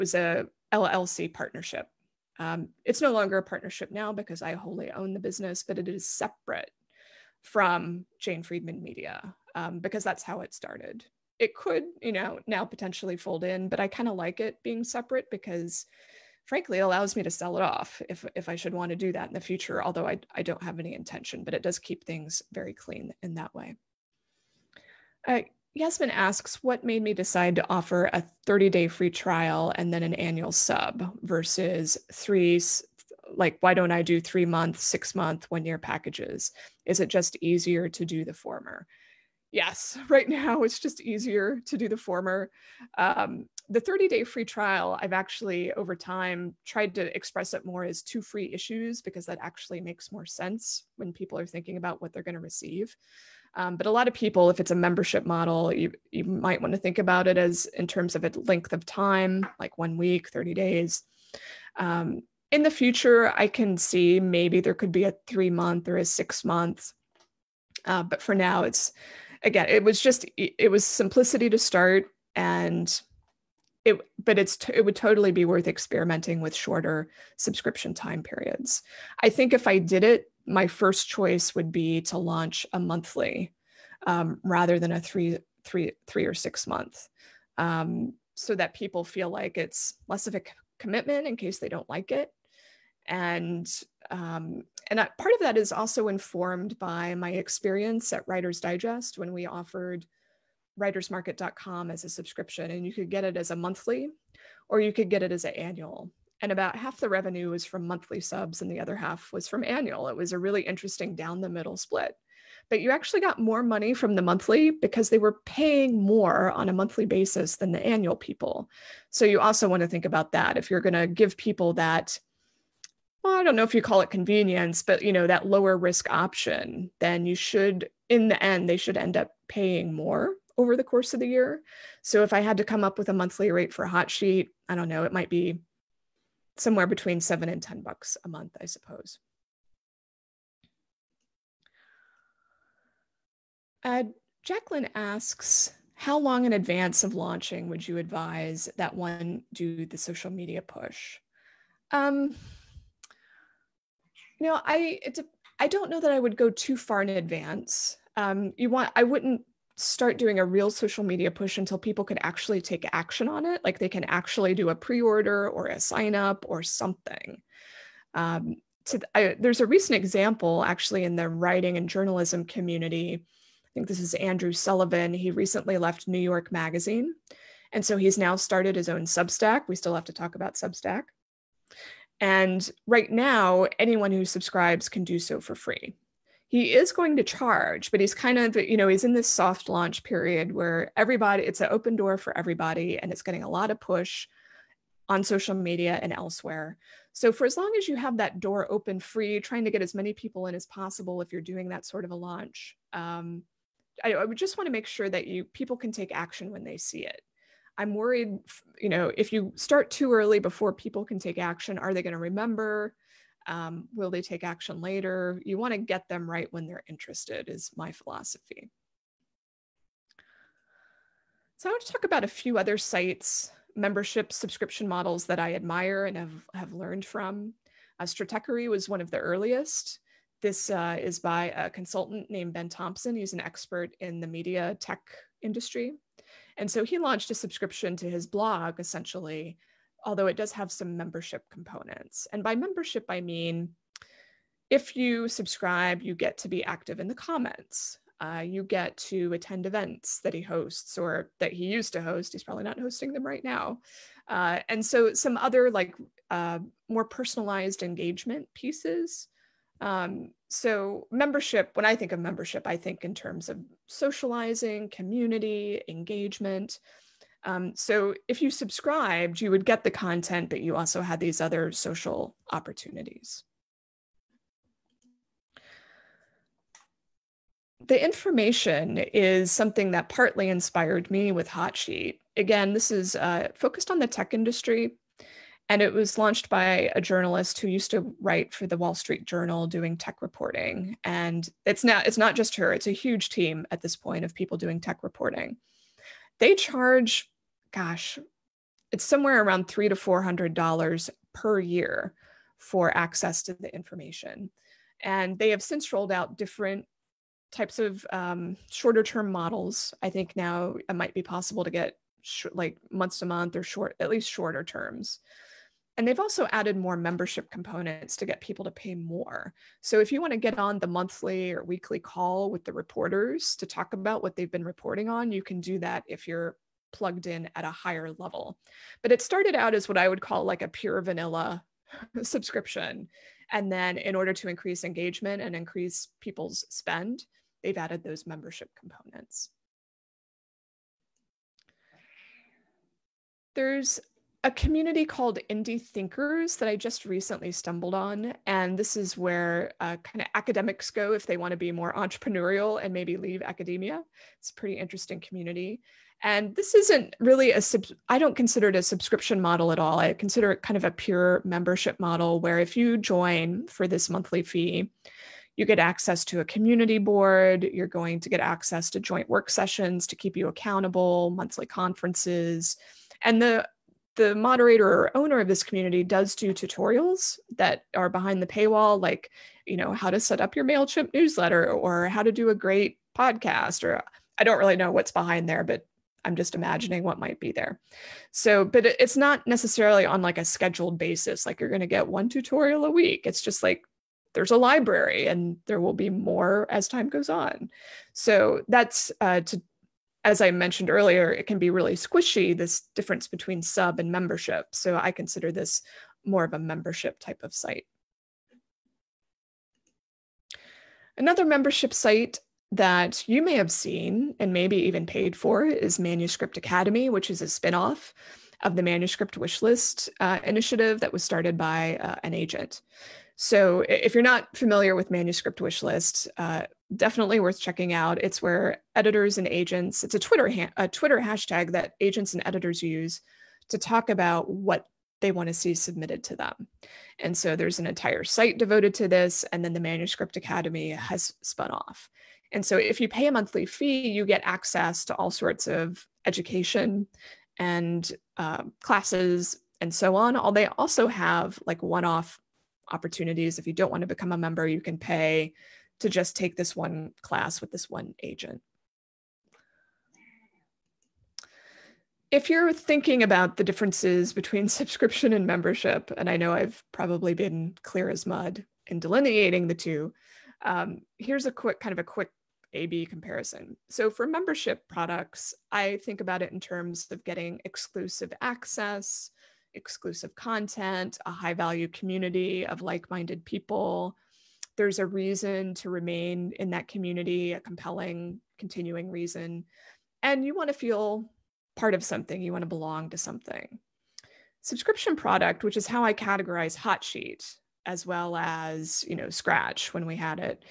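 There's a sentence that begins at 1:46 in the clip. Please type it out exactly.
And about half the revenue was from monthly subs, and the other half was from annual.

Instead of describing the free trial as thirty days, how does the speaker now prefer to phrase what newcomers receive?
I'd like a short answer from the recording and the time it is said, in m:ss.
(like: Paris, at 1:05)
two free issues, at 0:48.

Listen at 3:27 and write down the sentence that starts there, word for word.
I'm worried, you know, if you start too early before people can take action, are they going to remember?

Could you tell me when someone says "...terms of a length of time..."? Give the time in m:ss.
0:57.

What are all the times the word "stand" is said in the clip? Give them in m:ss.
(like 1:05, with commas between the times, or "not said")
not said.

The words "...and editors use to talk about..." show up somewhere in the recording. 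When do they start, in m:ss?
7:12.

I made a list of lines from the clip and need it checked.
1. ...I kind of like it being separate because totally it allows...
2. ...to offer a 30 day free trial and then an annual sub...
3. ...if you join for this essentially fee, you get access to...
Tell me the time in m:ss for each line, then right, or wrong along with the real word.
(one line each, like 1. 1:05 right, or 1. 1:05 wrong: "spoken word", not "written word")
1. 0:13 wrong: "frankly", not "totally"
2. 0:27 right
3. 6:02 wrong: "monthly", not "essentially".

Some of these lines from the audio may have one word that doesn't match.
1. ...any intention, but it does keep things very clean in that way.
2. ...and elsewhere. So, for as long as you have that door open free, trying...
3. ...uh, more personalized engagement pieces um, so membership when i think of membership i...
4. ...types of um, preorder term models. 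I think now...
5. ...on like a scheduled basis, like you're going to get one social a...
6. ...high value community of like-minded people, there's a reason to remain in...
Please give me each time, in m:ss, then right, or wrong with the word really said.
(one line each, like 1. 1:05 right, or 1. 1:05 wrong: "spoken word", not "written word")
1. 0:20 right
2. 3:16 right
3. 4:16 right
4. 5:07 wrong: "shorter", not "preorder"
5. 6:30 wrong: "tutorial", not "social"
6. 8:01 right.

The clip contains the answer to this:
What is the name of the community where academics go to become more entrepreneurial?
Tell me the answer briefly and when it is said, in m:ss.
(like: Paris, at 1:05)
Indie Thinkers, at 5:45.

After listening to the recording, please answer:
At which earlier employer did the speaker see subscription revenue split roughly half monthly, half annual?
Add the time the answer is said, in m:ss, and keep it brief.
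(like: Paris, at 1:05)
Writers Digest, at 1:38.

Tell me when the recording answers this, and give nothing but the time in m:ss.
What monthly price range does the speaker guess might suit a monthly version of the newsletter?
2:16.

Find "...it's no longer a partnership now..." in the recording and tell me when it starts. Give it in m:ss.
0:02.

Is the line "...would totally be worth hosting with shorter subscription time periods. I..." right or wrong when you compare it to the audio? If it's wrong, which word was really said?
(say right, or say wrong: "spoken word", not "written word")
wrong: "experimenting", not "hosting".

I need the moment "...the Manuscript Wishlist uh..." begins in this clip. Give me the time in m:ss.
6:58.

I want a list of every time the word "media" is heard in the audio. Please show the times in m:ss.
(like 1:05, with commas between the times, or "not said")
0:08, 2:30, 2:41, 3:15, 3:54.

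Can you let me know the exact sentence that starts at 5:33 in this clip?
And then in order to increase engagement and increase people's spend, they've added those membership components.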